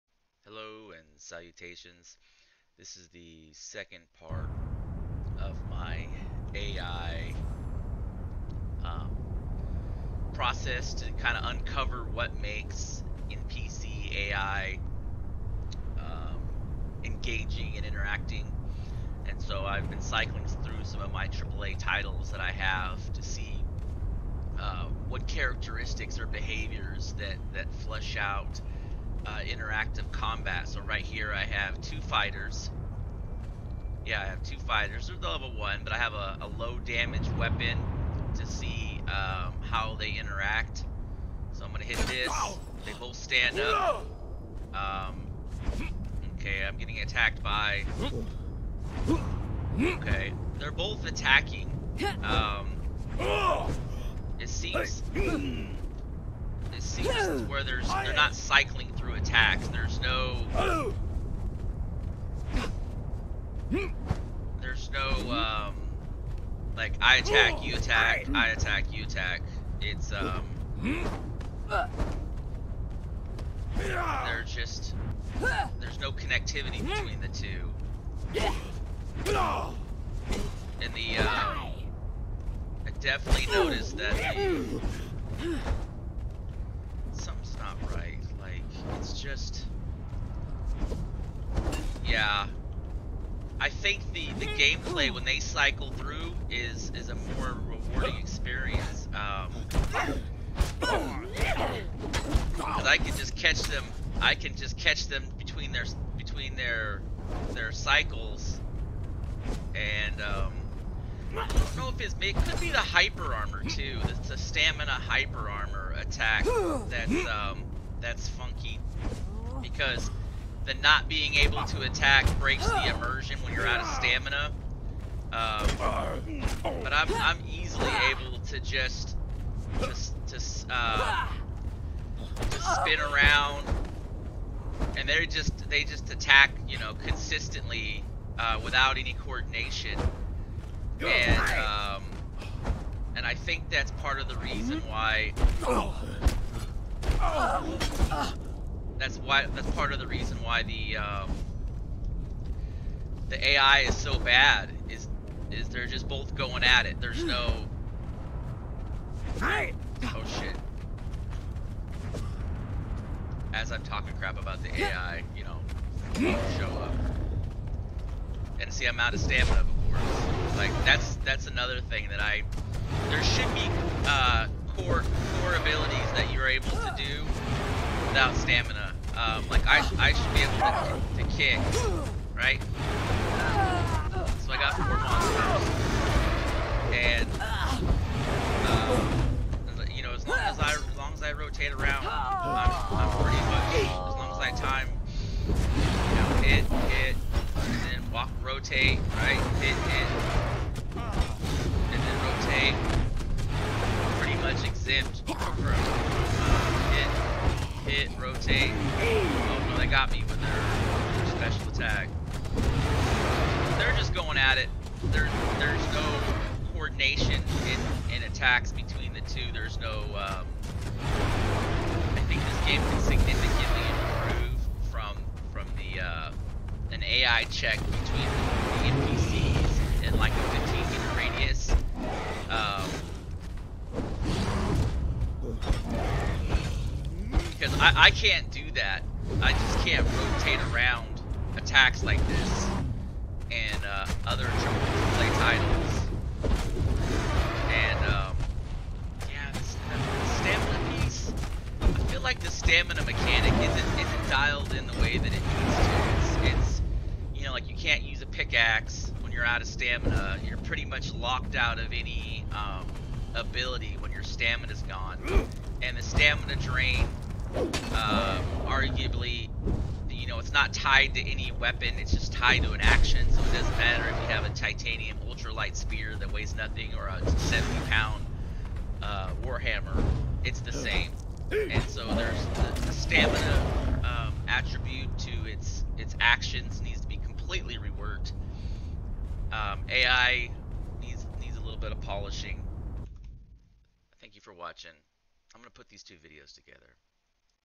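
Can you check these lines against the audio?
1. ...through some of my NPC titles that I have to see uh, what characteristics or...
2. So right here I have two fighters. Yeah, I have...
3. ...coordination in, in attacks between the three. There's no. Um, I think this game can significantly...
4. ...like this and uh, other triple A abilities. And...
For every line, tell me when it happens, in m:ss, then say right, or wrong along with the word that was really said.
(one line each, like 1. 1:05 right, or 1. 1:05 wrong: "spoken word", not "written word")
1. 0:20 wrong: "AAA", not "NPC"
2. 0:30 right
3. 3:36 wrong: "two", not "three"
4. 4:02 wrong: "titles", not "abilities".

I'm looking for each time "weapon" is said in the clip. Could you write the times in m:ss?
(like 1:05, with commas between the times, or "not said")
0:37, 4:31.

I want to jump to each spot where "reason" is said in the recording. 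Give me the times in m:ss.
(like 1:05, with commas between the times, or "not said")
2:24, 2:30.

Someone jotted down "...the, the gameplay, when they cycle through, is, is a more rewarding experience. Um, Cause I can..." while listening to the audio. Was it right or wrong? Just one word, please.
right.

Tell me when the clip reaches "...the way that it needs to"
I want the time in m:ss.
4:14.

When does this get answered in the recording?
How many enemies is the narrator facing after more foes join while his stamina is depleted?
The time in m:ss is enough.
3:04.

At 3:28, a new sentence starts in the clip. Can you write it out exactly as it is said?
Oh no, they got me with their special attack.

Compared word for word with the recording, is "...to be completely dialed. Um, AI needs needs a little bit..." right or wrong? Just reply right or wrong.
wrong.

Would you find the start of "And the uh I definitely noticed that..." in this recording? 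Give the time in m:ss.
1:20.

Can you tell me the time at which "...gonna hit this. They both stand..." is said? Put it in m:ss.
0:41.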